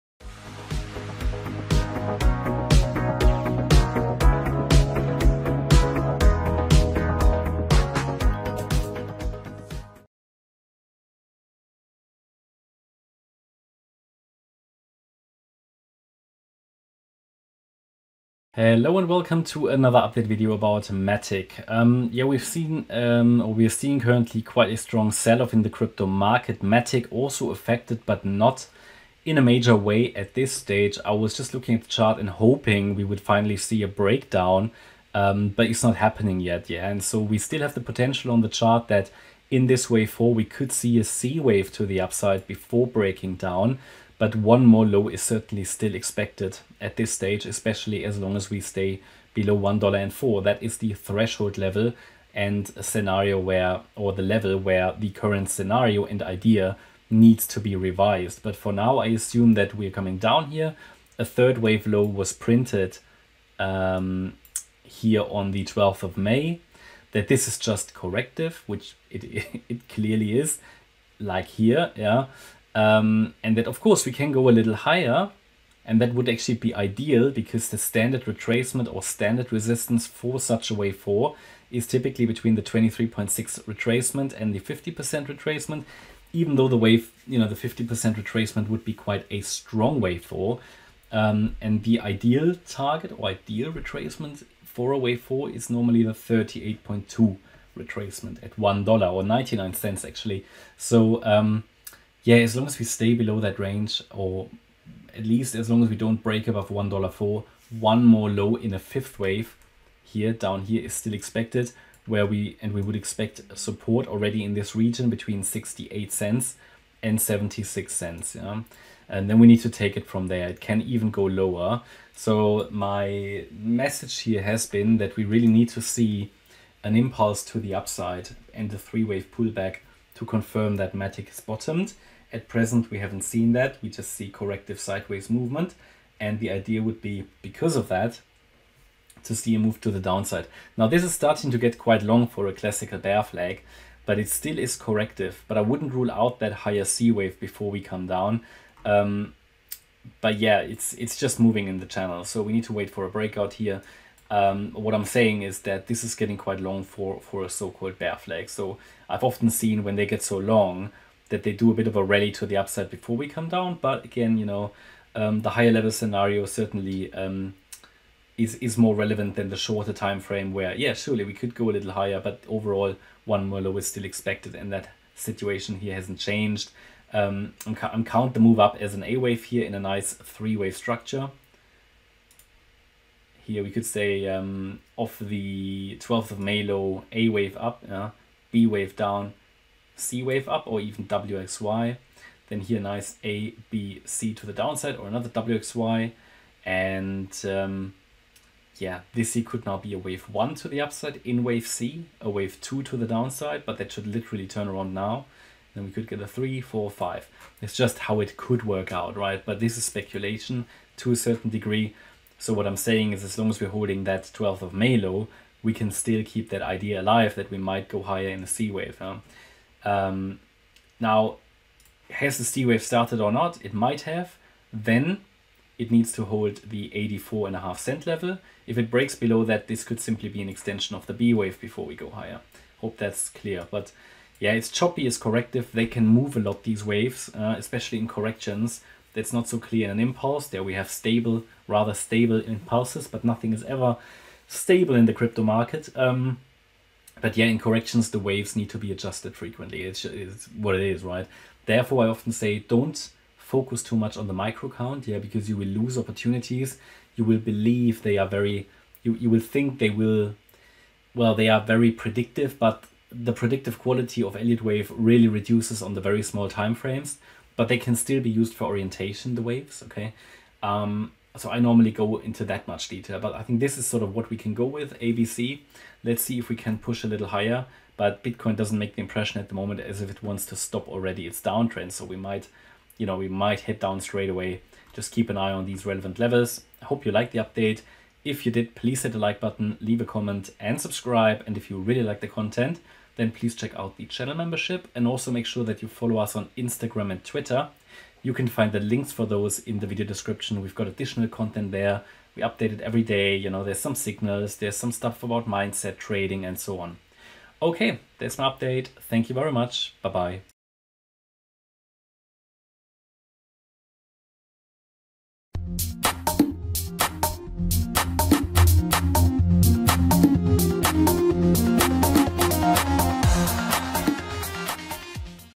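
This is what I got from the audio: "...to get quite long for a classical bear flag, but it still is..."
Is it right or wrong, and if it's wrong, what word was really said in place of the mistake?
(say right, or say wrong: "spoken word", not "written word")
right.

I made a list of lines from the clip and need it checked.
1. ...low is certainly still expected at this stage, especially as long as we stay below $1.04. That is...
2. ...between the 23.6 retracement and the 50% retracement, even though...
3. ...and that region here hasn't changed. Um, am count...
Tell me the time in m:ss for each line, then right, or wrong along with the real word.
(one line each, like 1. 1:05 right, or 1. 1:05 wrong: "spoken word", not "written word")
1. 0:44 right
2. 1:22 right
3. 2:54 wrong: "situation", not "region".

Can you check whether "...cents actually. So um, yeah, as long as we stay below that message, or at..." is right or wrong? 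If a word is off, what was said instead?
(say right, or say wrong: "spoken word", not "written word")
wrong: "range", not "message".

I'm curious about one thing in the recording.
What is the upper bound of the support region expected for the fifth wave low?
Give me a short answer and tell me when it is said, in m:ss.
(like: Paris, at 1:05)
76 cents, at 1:57.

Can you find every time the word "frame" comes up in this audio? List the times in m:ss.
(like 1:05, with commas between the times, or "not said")
2:50, 4:26.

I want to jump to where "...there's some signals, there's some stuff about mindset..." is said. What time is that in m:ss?
5:03.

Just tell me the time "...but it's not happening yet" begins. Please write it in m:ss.
0:35.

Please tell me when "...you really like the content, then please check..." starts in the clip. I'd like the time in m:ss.
4:51.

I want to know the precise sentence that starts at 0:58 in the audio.
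But for now, I assume that we're coming down here.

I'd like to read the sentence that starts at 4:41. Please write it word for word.
So we might, you know, we might head down straight away.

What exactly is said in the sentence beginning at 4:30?
Um, so I normally go into that much detail, but I think this is sort of what we can go with, ABC.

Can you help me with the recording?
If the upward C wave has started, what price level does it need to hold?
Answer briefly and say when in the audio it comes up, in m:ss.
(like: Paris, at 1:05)
84.5 cents, at 3:46.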